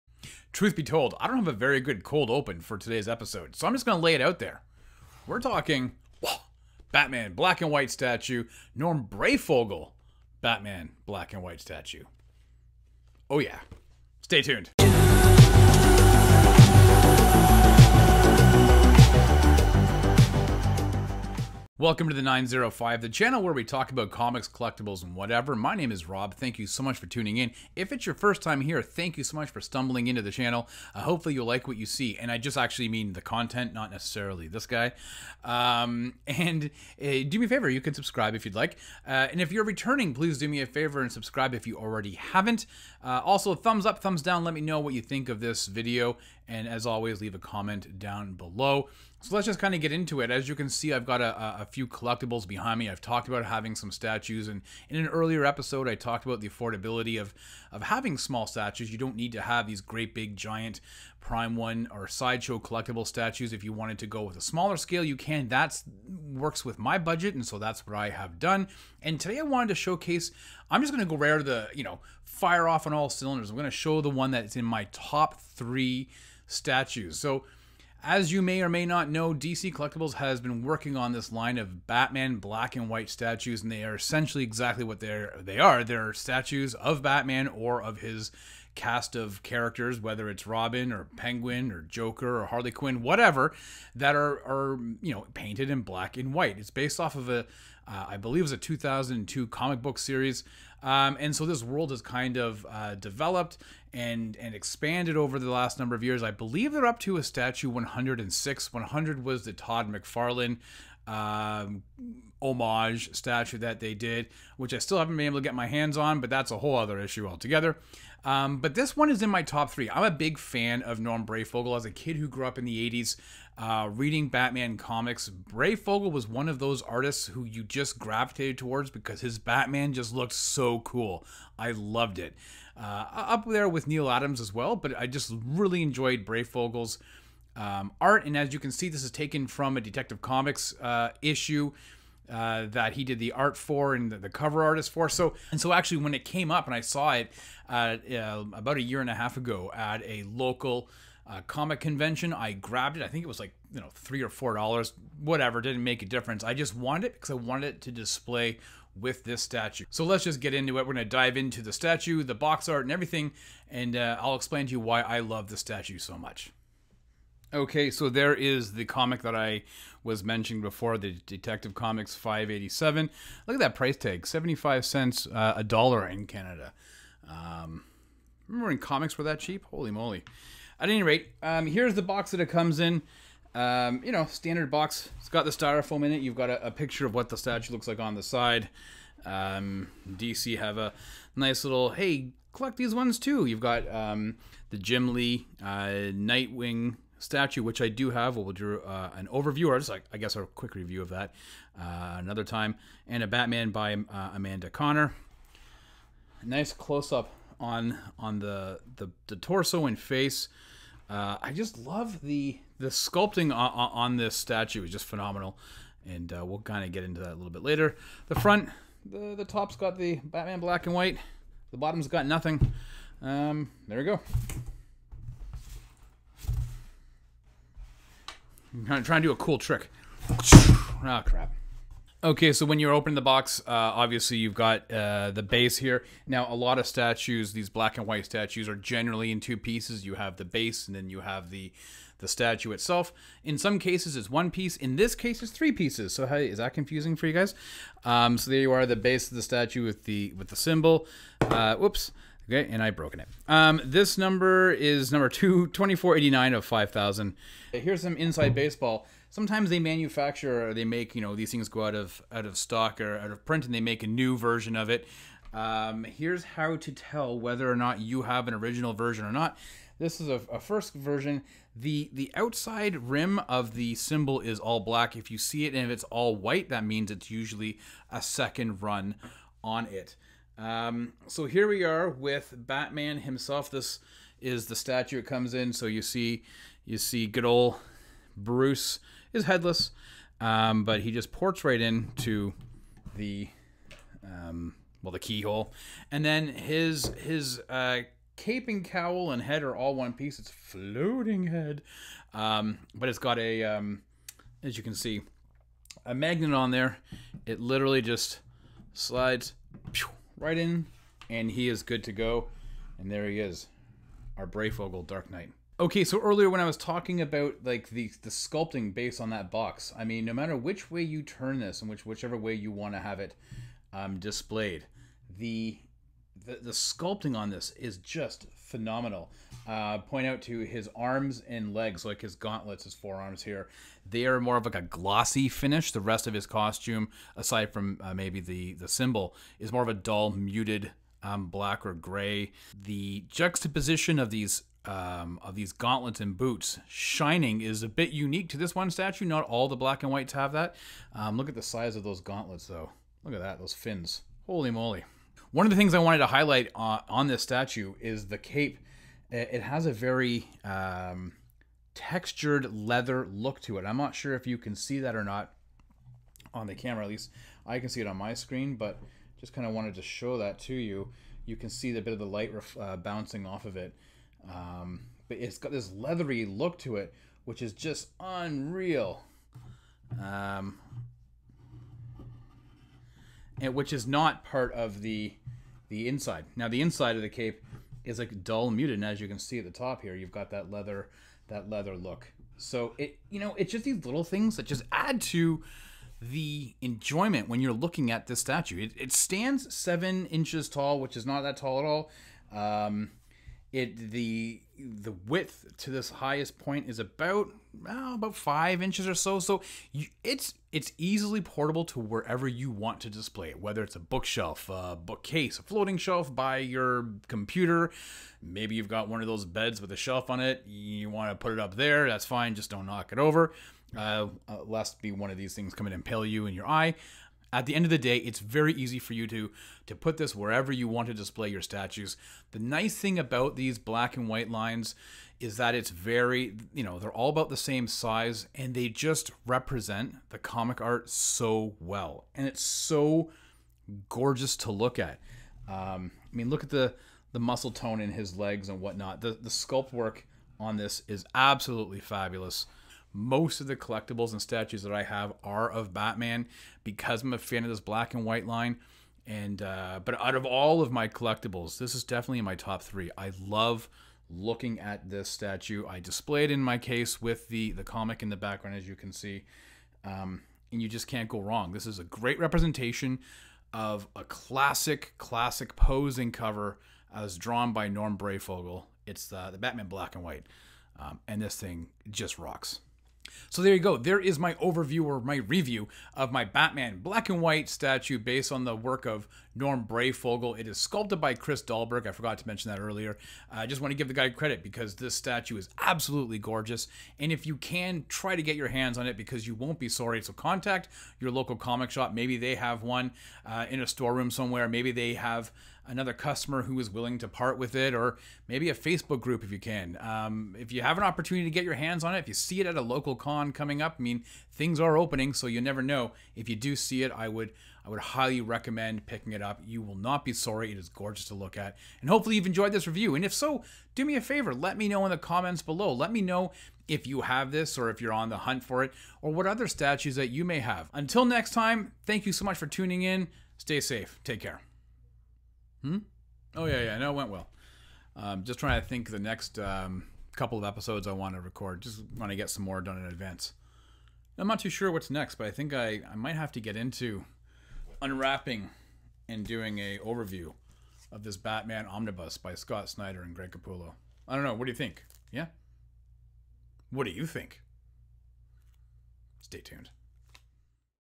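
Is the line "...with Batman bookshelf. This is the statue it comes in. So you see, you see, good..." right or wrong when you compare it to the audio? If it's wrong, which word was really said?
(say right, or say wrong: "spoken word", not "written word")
wrong: "himself", not "bookshelf".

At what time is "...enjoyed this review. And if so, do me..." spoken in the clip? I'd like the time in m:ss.
8:42.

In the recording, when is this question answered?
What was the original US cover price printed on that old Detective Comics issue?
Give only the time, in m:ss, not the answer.
2:54.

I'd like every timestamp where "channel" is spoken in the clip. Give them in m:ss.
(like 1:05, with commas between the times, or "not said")
0:23, 0:30.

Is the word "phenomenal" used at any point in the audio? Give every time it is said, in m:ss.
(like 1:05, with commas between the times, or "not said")
3:35, 5:28.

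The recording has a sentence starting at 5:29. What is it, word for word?
Uh, point out to his arms and legs, like his gauntlets, his forearms here, they are more of like a glossy finish.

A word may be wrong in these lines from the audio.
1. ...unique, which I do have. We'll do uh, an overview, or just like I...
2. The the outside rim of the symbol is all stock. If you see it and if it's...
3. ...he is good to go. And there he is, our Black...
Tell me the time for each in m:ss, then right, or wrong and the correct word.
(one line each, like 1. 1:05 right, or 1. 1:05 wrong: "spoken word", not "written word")
1. 3:17 wrong: "statue", not "unique"
2. 4:31 wrong: "black", not "stock"
3. 5:11 wrong: "Breyfogle", not "Black".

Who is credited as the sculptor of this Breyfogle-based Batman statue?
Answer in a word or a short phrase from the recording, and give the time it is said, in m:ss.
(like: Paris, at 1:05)
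Chris Dahlberg, at 8:11.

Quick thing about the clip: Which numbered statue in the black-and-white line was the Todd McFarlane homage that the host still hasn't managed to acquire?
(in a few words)
100.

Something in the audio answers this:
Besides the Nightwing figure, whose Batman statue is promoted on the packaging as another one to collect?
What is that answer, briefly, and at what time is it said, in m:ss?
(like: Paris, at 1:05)
Amanda Conner, at 3:24.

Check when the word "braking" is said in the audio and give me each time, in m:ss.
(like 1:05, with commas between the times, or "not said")
not said.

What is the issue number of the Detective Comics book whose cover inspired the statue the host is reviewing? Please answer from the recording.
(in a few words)
587.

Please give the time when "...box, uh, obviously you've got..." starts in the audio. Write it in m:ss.
3:53.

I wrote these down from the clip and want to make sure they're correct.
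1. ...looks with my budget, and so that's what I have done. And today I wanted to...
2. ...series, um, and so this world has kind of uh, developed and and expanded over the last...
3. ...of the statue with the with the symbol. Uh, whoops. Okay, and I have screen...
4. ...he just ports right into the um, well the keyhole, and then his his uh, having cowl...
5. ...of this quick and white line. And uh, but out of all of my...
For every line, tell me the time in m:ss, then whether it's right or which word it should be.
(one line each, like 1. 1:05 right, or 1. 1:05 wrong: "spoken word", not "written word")
1. 1:06 wrong: "works", not "looks"
2. 1:39 right
3. 4:09 wrong: "broken", not "screen"
4. 4:51 wrong: "caping", not "having"
5. 7:37 wrong: "black", not "quick".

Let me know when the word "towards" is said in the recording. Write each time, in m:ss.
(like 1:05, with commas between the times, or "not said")
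2:08.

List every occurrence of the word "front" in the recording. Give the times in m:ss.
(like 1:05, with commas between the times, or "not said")
3:38.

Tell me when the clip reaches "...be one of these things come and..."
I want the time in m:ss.
7:05.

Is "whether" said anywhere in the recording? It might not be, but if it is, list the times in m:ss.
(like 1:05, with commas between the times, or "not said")
1:29, 4:27, 6:53.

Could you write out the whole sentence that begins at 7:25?
Um, I mean, look at the, the muscle tone in his legs and whatnot.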